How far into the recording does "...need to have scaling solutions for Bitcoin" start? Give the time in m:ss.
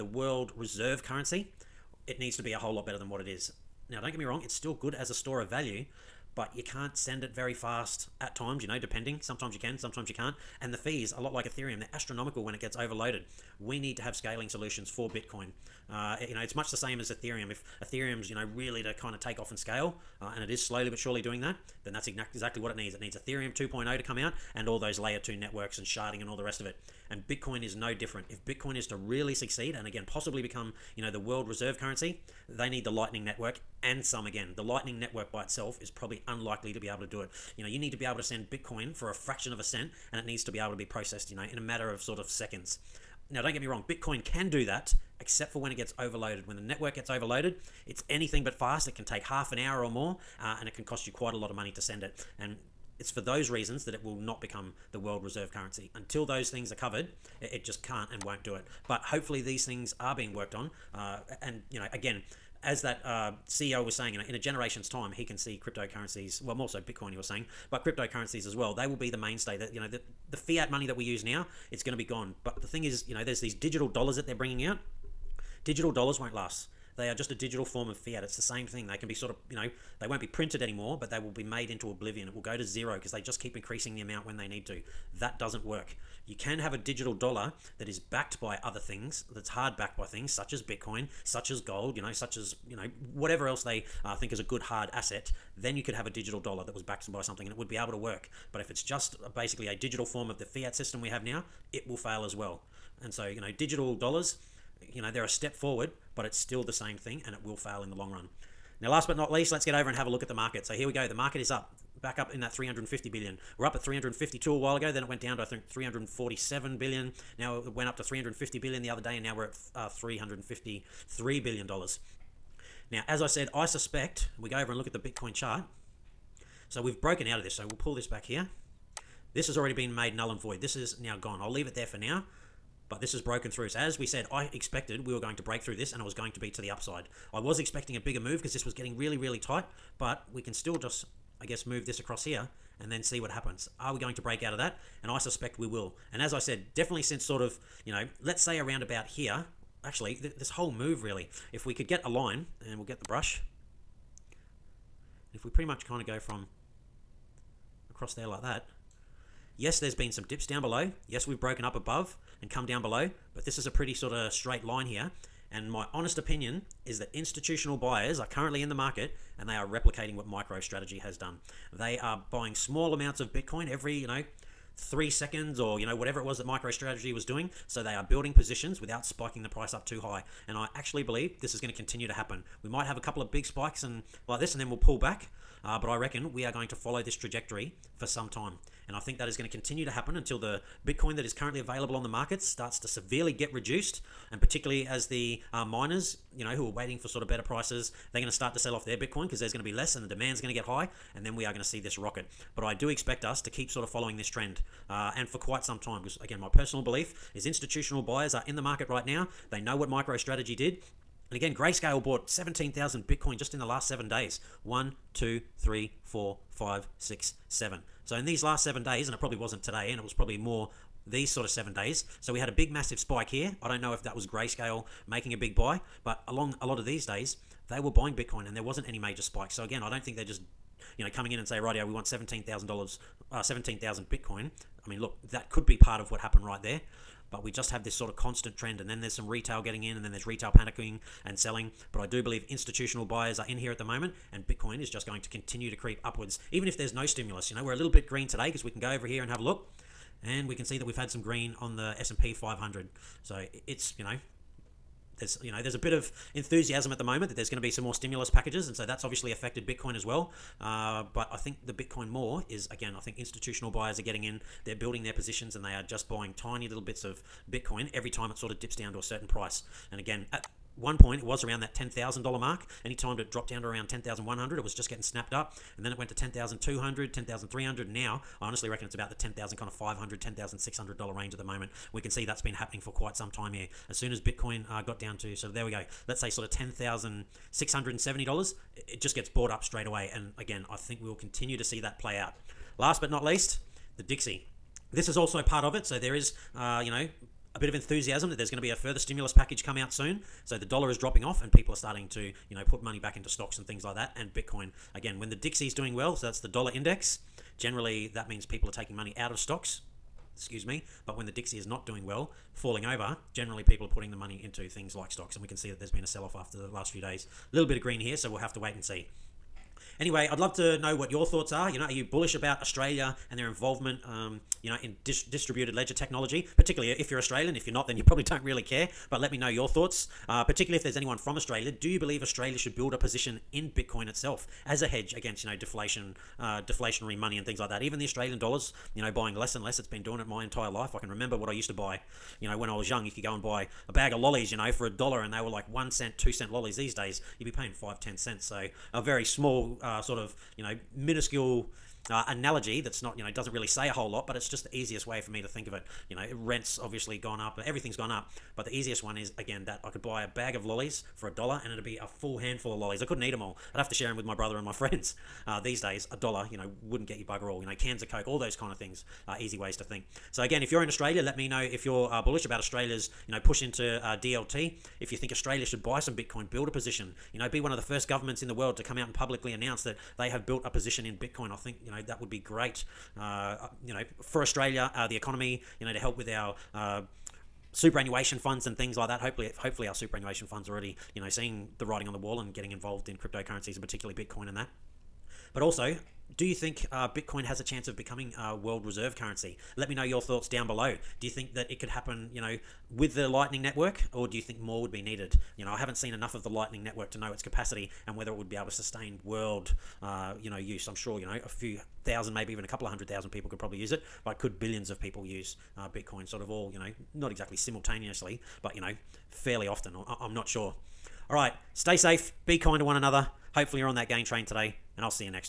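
0:13.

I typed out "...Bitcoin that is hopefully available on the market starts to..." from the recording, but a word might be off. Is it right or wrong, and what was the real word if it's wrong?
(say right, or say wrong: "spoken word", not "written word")
wrong: "currently", not "hopefully".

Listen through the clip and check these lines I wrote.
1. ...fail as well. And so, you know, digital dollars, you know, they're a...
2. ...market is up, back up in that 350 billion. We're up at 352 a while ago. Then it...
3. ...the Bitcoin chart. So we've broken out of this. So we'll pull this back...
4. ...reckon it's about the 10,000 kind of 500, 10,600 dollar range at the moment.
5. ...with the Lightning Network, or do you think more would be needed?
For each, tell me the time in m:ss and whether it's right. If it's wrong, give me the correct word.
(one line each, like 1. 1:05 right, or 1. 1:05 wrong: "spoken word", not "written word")
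1. 1:41 right
2. 1:51 right
3. 2:04 right
4. 4:38 right
5. 6:42 right.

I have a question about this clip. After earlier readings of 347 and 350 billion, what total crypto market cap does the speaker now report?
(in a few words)
$353 billion.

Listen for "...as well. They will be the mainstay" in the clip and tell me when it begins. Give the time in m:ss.
1:08.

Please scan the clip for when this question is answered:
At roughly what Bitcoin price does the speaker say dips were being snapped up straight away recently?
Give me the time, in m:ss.
4:46.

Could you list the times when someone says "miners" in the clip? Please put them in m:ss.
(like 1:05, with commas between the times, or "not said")
3:15.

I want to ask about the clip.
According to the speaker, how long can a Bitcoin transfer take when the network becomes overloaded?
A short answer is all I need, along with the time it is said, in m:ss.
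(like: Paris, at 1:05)
half an hour or more, at 0:49.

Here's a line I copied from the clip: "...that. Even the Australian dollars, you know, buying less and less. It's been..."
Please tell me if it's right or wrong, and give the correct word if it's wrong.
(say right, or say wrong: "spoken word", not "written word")
right.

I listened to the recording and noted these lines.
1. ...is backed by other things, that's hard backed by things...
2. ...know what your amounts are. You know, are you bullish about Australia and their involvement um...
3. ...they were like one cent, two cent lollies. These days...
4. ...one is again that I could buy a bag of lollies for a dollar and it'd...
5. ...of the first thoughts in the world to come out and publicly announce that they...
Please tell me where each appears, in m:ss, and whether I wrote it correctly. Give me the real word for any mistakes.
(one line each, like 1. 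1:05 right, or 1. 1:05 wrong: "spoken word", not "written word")
1. 1:27 right
2. 5:20 wrong: "thoughts", not "amounts"
3. 5:45 right
4. 5:59 right
5. 6:17 wrong: "governments", not "thoughts".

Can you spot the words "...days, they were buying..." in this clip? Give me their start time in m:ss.
3:47.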